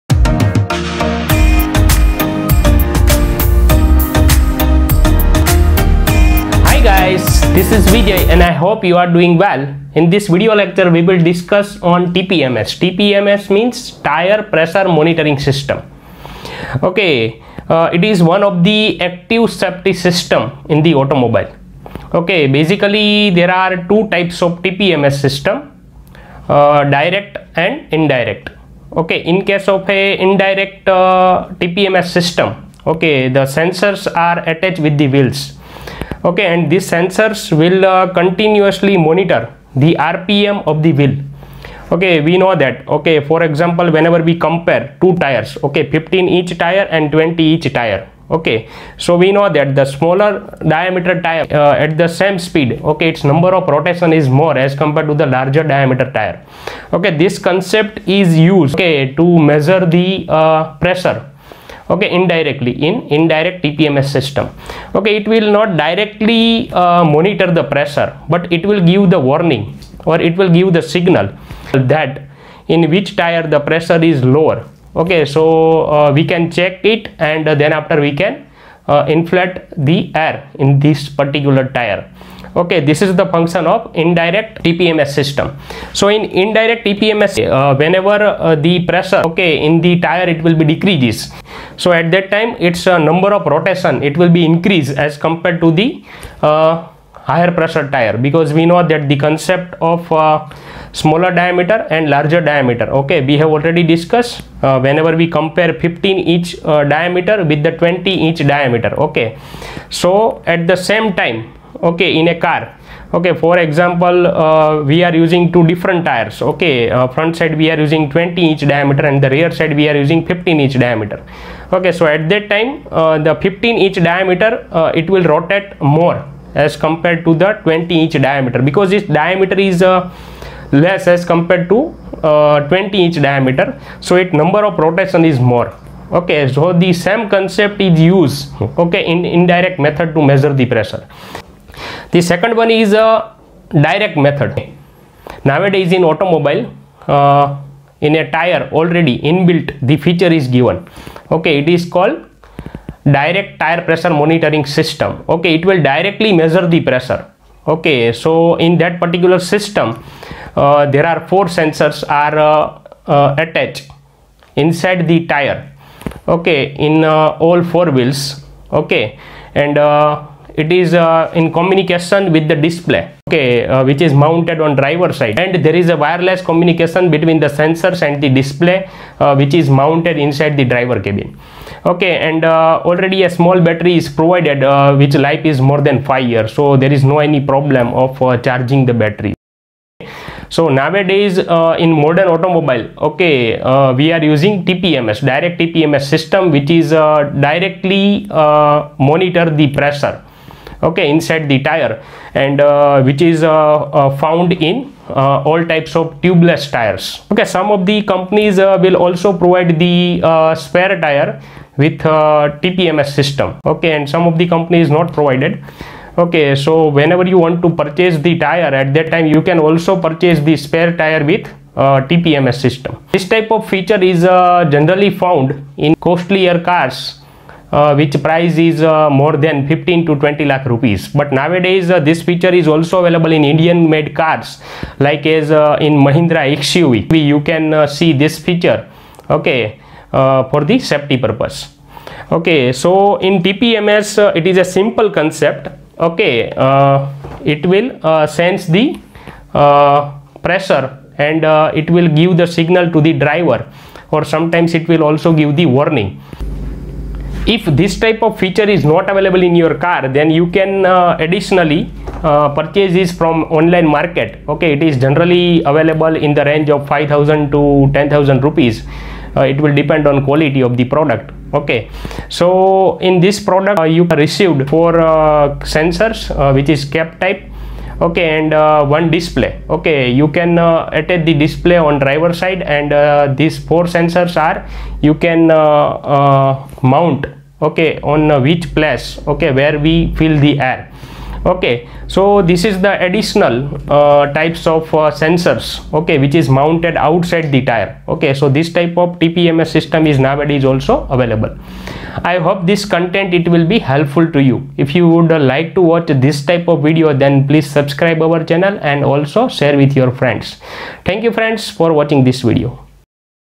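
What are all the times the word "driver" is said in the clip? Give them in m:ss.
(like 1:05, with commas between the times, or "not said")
2:54, 3:00, 4:13, 4:41.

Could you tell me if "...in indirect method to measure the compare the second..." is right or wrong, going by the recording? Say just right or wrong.
wrong.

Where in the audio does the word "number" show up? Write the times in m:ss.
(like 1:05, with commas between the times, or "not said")
0:53, 1:32, 2:14.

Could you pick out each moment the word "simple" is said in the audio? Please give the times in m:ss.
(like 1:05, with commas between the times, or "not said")
4:04.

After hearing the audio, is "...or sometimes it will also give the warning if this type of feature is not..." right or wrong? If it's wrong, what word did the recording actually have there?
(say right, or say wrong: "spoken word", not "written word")
right.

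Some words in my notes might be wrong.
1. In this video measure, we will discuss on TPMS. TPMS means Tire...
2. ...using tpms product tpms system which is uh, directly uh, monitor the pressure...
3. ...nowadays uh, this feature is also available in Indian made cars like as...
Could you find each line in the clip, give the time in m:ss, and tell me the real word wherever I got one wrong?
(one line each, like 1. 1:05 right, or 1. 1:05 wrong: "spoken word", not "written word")
1. 0:09 wrong: "lecture", not "measure"
2. 3:14 wrong: "direct", not "product"
3. 3:51 right.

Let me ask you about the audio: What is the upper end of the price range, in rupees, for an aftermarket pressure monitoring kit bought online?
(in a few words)
10000 rupees.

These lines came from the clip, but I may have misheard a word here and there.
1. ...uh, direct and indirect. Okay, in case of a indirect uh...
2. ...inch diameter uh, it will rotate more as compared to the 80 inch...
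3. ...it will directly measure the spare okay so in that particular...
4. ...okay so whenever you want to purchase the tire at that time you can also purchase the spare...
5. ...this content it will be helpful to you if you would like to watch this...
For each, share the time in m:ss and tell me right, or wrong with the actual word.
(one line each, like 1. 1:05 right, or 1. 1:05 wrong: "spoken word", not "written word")
1. 0:26 right
2. 2:03 wrong: "20", not "80"
3. 2:35 wrong: "pressure", not "spare"
4. 3:36 right
5. 5:02 right.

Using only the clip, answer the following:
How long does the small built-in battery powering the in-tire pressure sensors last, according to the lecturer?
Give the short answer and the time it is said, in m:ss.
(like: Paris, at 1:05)
more than 5 years, at 3:05.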